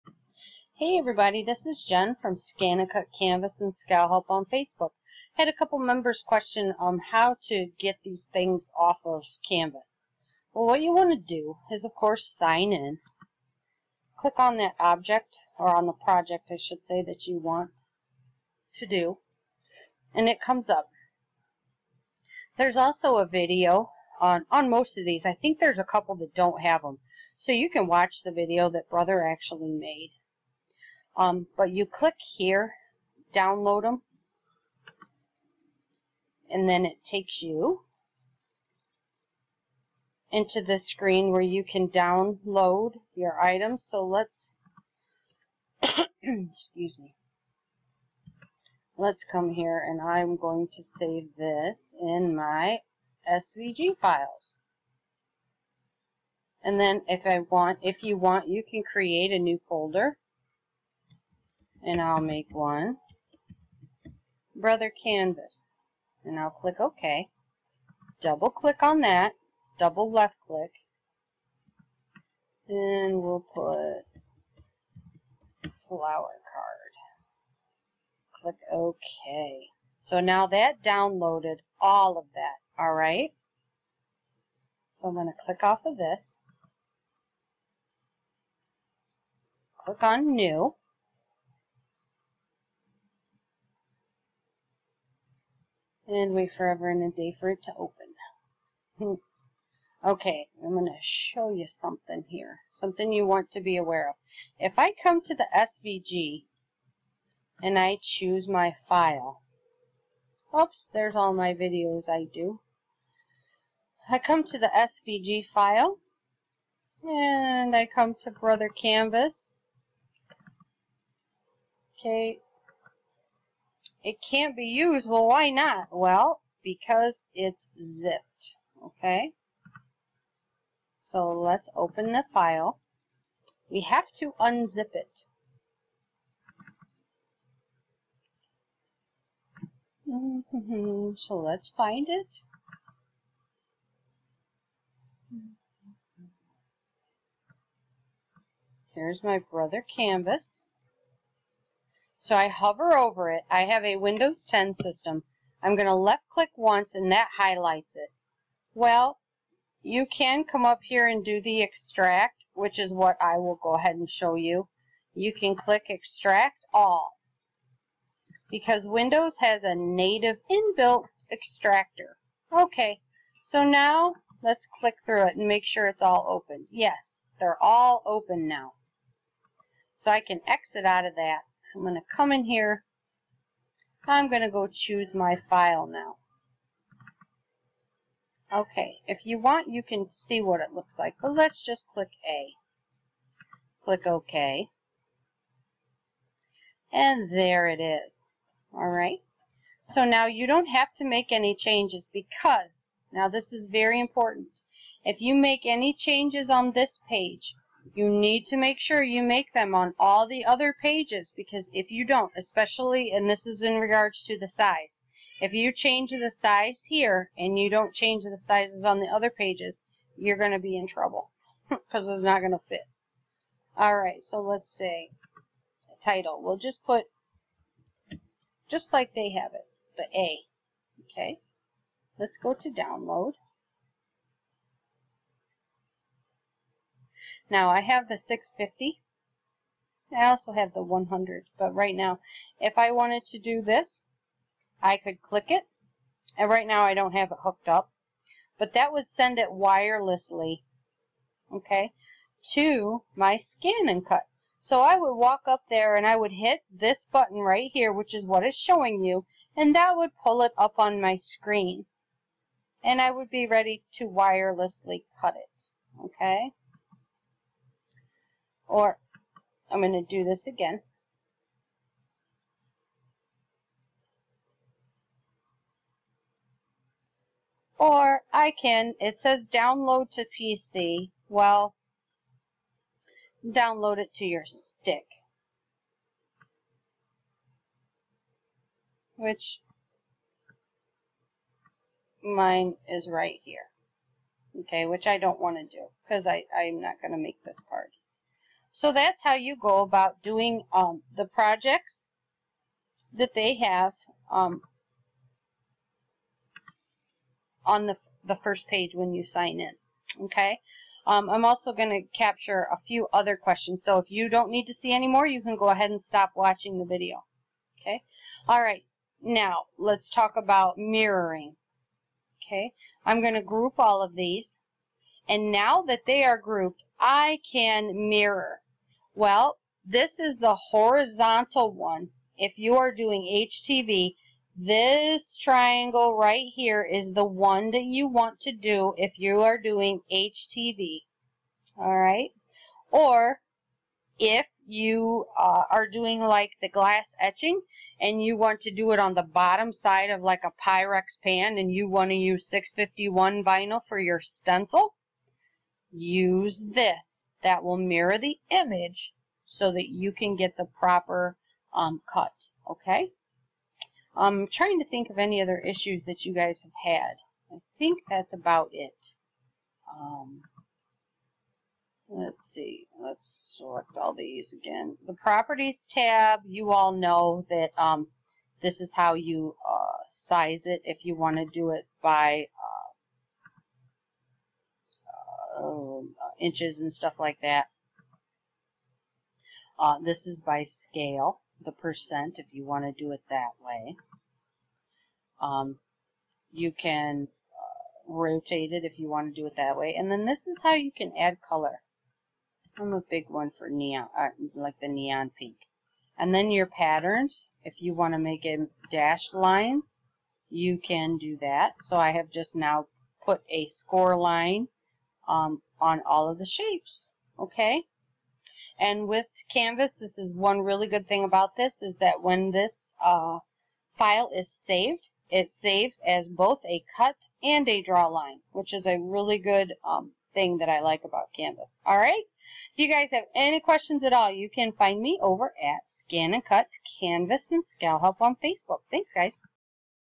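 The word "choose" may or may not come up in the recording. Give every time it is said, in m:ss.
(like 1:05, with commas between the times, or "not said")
1:48, 3:04.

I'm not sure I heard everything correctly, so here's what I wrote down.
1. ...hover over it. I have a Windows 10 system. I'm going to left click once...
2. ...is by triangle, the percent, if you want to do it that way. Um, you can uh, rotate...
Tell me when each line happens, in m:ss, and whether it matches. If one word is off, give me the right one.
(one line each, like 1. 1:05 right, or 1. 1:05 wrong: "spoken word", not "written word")
1. 2:32 right
2. 6:30 wrong: "scale", not "triangle".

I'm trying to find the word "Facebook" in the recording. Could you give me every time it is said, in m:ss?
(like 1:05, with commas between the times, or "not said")
0:04, 7:18.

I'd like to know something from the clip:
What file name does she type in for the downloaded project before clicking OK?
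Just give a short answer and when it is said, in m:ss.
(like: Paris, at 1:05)
flower card, at 1:15.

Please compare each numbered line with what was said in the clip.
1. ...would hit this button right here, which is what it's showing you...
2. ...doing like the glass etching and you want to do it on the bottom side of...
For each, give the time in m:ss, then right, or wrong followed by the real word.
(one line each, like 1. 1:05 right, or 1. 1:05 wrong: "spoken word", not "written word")
1. 4:16 right
2. 5:45 right.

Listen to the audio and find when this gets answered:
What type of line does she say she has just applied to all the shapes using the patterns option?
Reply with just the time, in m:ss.
6:53.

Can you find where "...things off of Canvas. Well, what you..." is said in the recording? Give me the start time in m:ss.
0:08.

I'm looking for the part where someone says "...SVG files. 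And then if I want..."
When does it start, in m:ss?
0:53.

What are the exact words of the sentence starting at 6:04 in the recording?
I'm trying to think of any other issues that you guys have had.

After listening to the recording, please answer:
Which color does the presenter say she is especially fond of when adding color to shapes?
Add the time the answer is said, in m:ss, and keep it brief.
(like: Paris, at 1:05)
neon pink, at 6:44.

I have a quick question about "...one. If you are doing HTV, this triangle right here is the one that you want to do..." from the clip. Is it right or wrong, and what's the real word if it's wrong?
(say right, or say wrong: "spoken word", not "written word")
right.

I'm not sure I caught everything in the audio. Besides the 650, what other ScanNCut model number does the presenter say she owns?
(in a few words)
100.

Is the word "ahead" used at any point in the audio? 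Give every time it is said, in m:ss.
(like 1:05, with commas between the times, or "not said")
2:43, 5:15.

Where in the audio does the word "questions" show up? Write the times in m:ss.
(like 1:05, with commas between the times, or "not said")
0:06, 5:13, 7:13.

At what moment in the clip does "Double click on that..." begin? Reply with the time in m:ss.
1:08.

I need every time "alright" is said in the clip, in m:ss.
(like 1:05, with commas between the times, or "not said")
1:22, 3:18, 3:43.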